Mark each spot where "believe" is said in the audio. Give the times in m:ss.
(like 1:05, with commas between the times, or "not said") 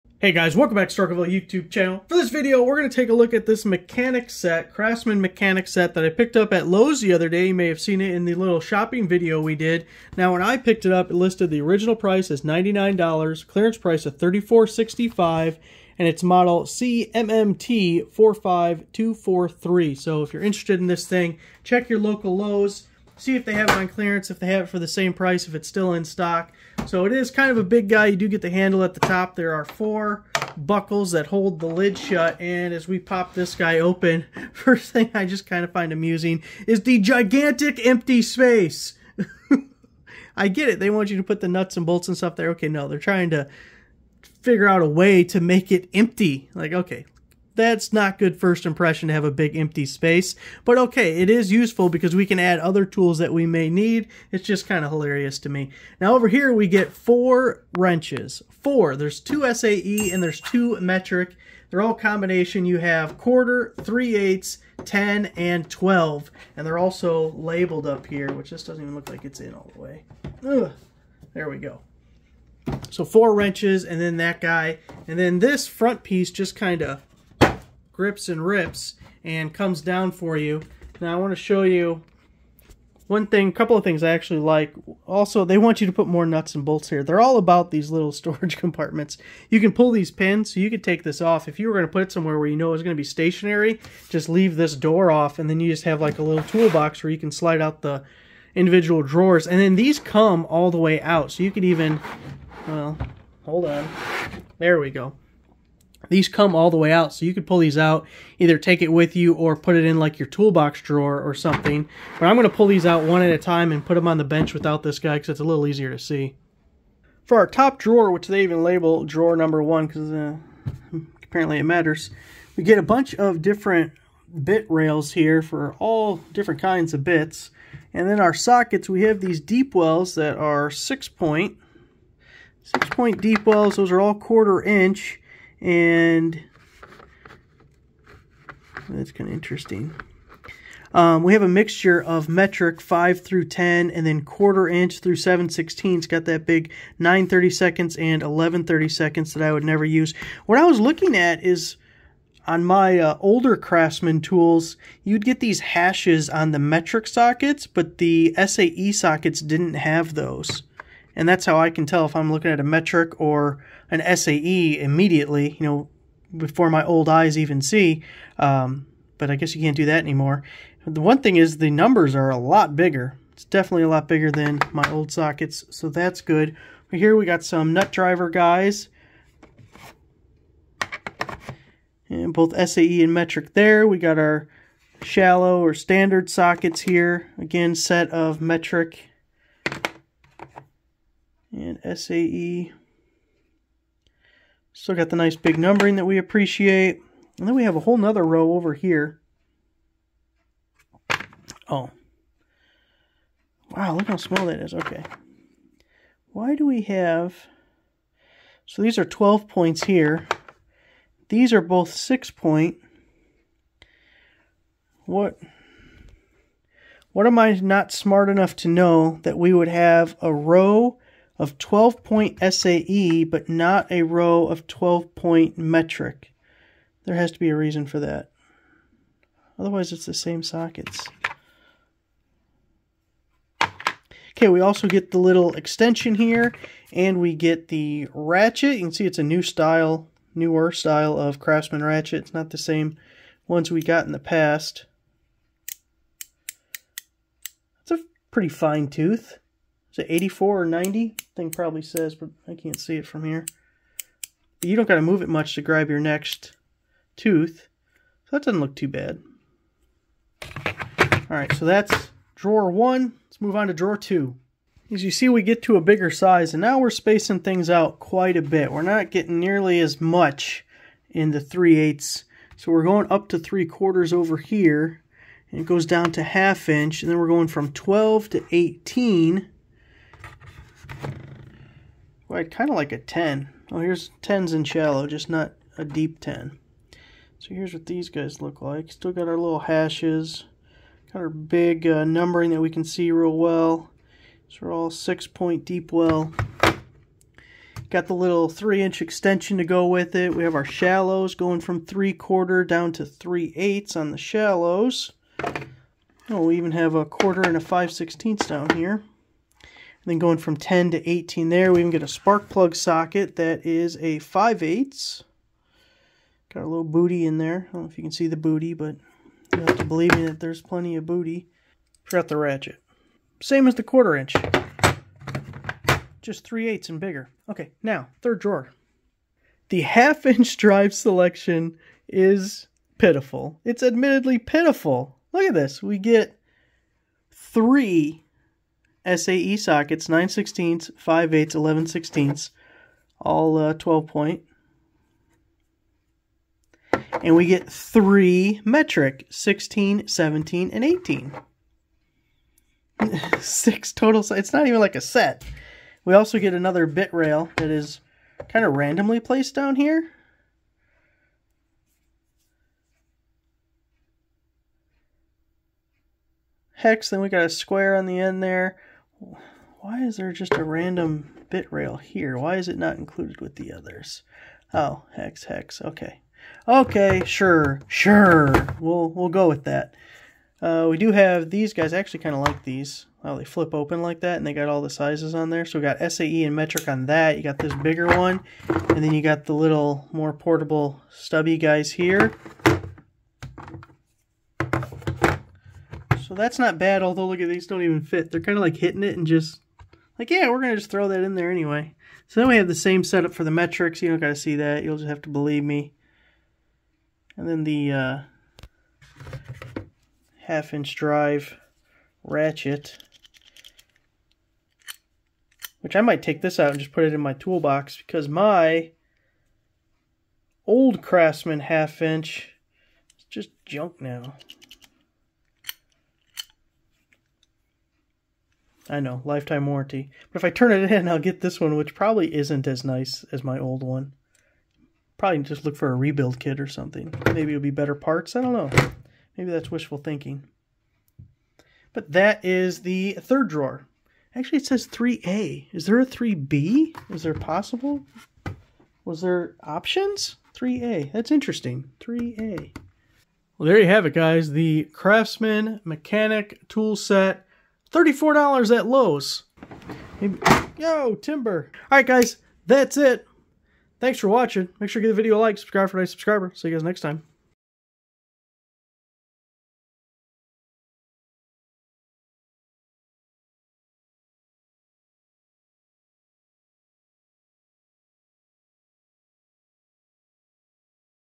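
5:19, 6:45.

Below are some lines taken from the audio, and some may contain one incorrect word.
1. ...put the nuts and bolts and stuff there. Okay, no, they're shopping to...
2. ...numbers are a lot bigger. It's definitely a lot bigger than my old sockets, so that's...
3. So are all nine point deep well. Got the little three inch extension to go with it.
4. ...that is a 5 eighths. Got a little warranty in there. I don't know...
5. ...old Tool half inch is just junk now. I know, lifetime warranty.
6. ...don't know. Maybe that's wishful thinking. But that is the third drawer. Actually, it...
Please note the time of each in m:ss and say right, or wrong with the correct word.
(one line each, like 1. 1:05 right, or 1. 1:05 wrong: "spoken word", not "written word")
1. 0:41 wrong: "trying", not "shopping"
2. 2:51 right
3. 4:54 wrong: "six", not "nine"
4. 5:13 wrong: "booty", not "warranty"
5. 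7:00 wrong: "Craftsman", not "Tool"
6. 7:18 right.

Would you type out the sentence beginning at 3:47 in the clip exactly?
There has to be a reason for that.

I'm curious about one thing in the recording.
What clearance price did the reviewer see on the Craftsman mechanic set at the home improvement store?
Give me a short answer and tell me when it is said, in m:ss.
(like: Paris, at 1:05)
$34.65, at 0:14.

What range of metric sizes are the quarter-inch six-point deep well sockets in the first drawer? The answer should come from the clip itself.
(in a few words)
5 through 10.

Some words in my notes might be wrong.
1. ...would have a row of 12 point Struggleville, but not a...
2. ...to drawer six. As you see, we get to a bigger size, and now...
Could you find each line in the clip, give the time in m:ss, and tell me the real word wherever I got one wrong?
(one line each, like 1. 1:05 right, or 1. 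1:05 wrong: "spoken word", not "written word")
1. 3:39 wrong: "SAE", not "Struggleville"
2. 4:23 wrong: "two", not "six".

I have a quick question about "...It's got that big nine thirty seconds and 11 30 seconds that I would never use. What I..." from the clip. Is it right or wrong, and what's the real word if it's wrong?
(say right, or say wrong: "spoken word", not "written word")
right.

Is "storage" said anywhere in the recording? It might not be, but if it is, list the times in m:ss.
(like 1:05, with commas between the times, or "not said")
1:28.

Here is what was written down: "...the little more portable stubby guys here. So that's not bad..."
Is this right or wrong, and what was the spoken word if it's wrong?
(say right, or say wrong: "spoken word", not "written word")
right.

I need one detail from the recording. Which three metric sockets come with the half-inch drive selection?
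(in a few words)
16, 17, and 18.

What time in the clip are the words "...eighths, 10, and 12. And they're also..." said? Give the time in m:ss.
1:04.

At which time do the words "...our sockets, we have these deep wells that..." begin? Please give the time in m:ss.
2:08.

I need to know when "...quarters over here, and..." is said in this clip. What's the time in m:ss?
4:33.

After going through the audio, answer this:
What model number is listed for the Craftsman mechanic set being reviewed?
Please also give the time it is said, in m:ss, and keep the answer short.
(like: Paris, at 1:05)
CMMT45243, at 0:16.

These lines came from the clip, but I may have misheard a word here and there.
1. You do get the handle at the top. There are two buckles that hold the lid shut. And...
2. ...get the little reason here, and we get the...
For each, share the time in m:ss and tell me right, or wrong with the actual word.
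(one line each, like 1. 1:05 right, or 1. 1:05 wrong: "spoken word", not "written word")
1. 0:28 wrong: "four", not "two"
2. 3:54 wrong: "extension", not "reason".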